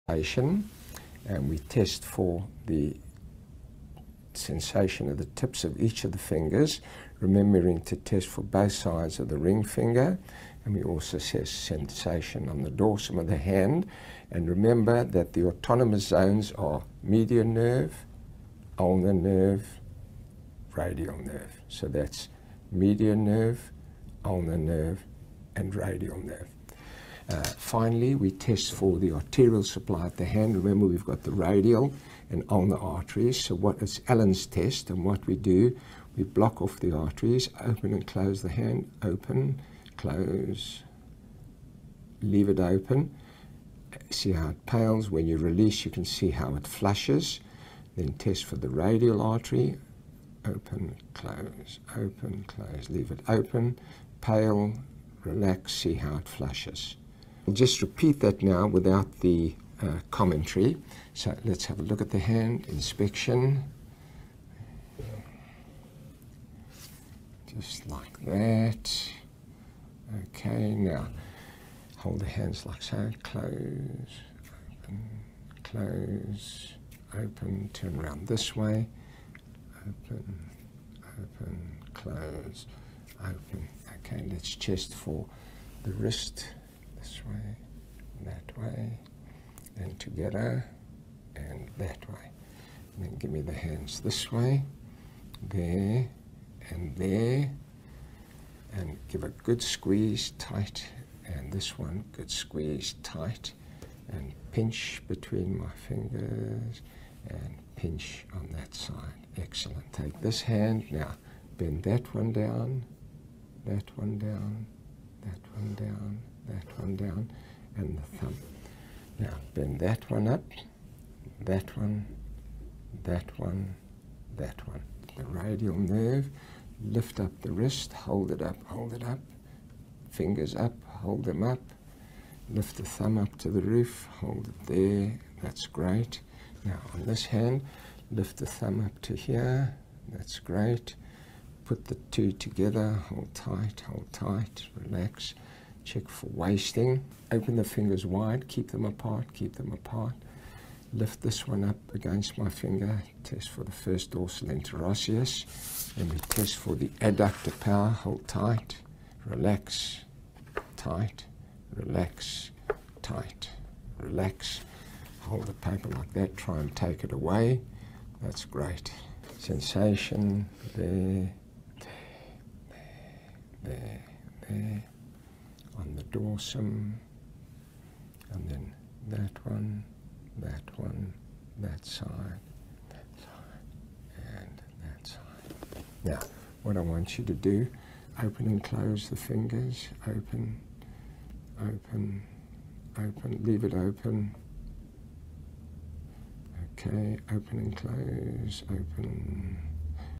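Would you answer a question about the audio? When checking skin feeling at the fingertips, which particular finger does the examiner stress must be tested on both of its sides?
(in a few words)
ring finger.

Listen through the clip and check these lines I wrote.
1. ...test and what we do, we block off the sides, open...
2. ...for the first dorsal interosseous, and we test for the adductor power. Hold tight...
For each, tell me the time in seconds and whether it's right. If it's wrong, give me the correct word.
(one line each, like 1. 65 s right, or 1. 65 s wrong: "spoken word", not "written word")
1. 34 s wrong: "arteries", not "sides"
2. 153 s right.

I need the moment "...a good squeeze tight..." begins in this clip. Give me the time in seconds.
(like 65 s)
99 s.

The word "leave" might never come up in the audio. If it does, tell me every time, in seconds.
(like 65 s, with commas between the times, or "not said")
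42 s, 52 s, 193 s.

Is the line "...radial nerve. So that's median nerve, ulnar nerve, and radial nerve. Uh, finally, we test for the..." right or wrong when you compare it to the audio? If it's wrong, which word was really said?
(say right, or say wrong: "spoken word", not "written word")
right.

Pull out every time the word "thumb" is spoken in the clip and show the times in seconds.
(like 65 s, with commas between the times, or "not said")
118 s, 132 s, 138 s.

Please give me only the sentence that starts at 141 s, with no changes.
Put the two together, hold tight, hold tight, relax check for wasting.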